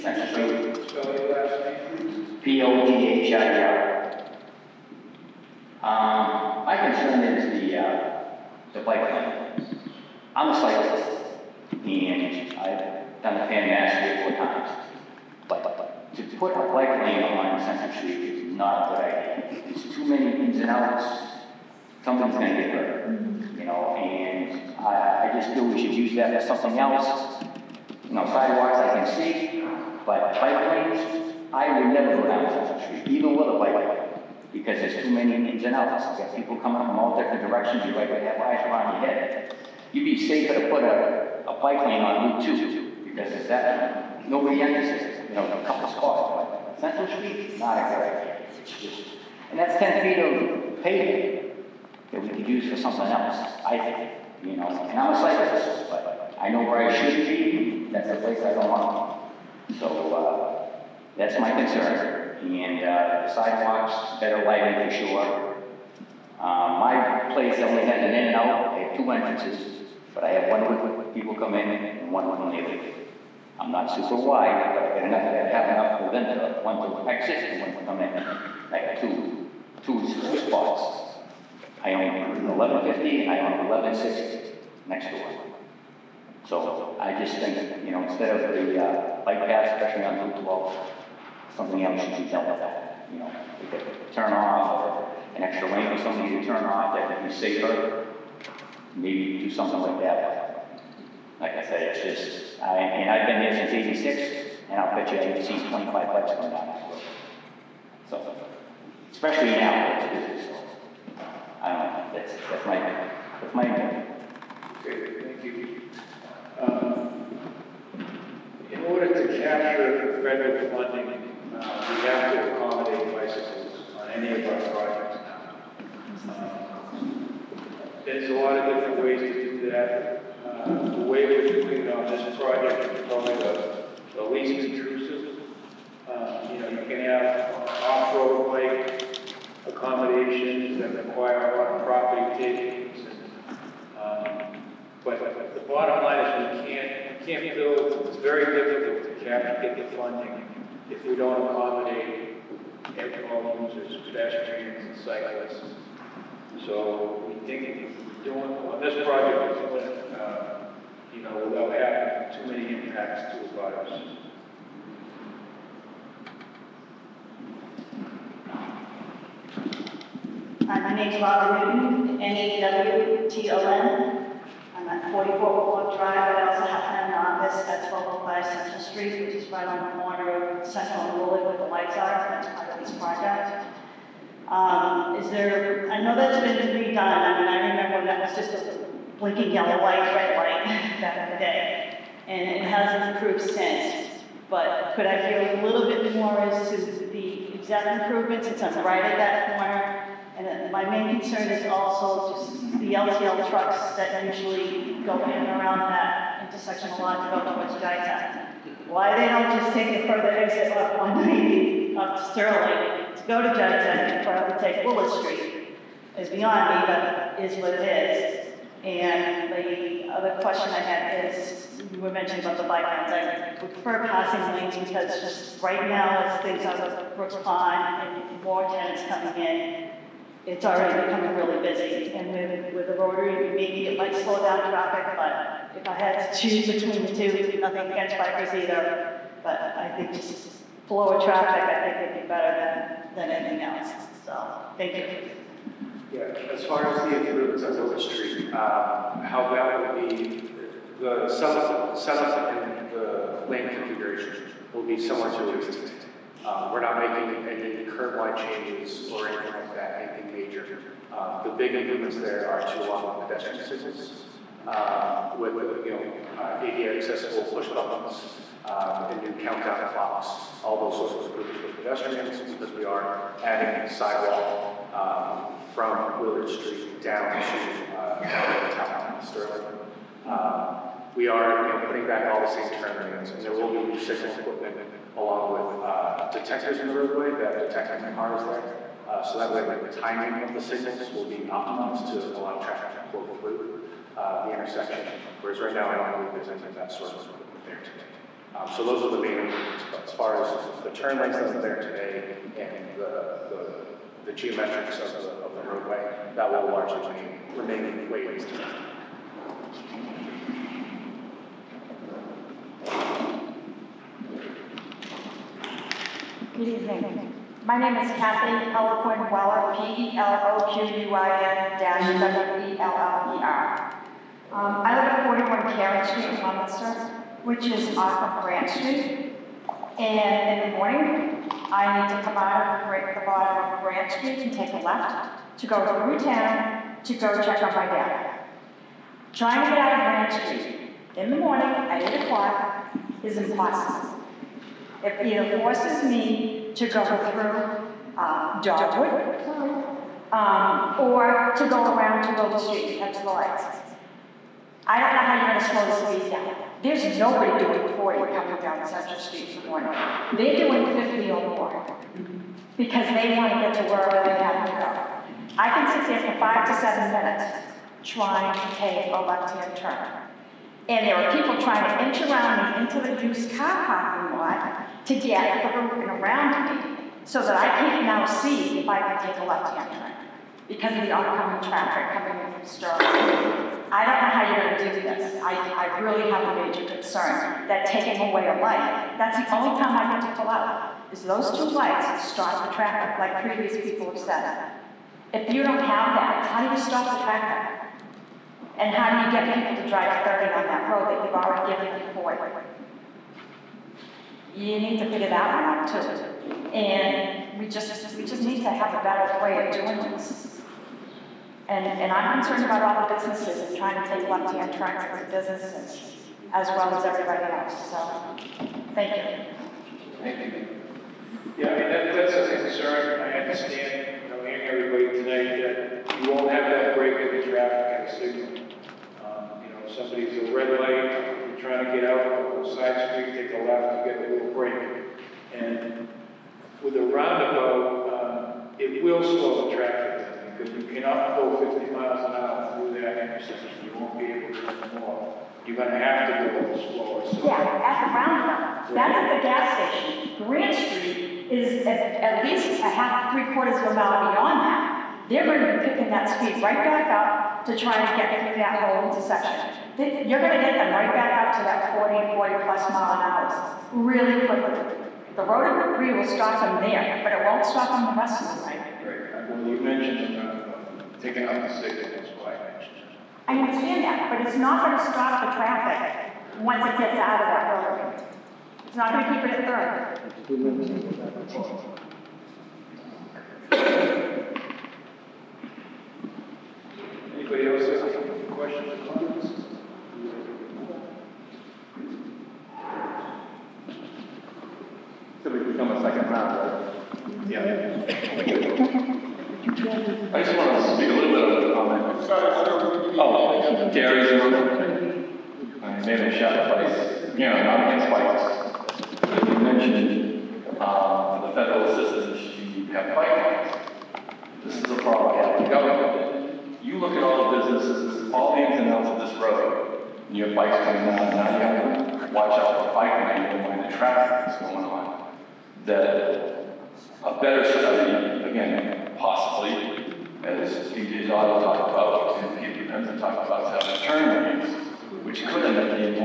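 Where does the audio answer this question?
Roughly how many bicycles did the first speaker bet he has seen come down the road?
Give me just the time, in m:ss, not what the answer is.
1:45.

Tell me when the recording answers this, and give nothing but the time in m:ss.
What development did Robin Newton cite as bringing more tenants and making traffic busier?
3:47.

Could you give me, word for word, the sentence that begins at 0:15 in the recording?
But to put a bike lane on Central Street is not a good idea.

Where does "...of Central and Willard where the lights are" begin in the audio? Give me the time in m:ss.
3:00.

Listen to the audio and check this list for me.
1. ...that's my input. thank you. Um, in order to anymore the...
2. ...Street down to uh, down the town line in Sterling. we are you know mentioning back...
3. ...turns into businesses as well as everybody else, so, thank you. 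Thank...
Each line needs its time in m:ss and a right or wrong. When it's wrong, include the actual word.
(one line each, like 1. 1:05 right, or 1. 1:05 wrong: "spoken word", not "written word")
1. 1:53 wrong: "capture", not "anymore"
2. 4:36 wrong: "putting", not "mentioning"
3. 6:54 right.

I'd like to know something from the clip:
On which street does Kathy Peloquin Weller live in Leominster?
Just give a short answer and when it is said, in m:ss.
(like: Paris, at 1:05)
Karen Street, at 5:25.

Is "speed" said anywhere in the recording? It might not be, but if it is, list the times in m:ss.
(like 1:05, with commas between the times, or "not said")
5:55, 7:36.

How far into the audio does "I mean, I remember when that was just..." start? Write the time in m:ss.
3:06.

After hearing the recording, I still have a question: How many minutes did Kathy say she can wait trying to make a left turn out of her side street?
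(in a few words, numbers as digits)
5 to 7.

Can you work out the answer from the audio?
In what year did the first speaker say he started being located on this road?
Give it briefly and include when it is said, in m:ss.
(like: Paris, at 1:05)
1986, at 1:43.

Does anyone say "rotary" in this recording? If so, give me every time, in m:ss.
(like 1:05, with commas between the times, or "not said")
3:52, 7:45, 7:57.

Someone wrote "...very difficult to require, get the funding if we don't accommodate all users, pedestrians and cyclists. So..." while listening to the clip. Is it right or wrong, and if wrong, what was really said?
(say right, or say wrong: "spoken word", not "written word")
wrong: "capture", not "require".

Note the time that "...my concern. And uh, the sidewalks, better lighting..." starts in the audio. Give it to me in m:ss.
1:01.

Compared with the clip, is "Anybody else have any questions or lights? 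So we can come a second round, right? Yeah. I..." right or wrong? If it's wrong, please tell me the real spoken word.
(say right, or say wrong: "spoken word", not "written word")
wrong: "comments", not "lights".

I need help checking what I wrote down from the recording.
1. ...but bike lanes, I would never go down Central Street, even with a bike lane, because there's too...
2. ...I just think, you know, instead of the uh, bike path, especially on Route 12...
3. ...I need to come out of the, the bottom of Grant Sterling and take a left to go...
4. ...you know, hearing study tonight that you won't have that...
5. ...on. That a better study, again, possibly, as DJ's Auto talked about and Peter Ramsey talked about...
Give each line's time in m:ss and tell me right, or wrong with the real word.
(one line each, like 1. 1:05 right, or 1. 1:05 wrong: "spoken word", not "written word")
1. 0:30 right
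2. 1:26 right
3. 5:31 wrong: "Street", not "Sterling"
4. 7:04 wrong: "everybody", not "study"
5. 8:44 right.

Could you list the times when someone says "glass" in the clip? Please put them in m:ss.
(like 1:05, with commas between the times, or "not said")
not said.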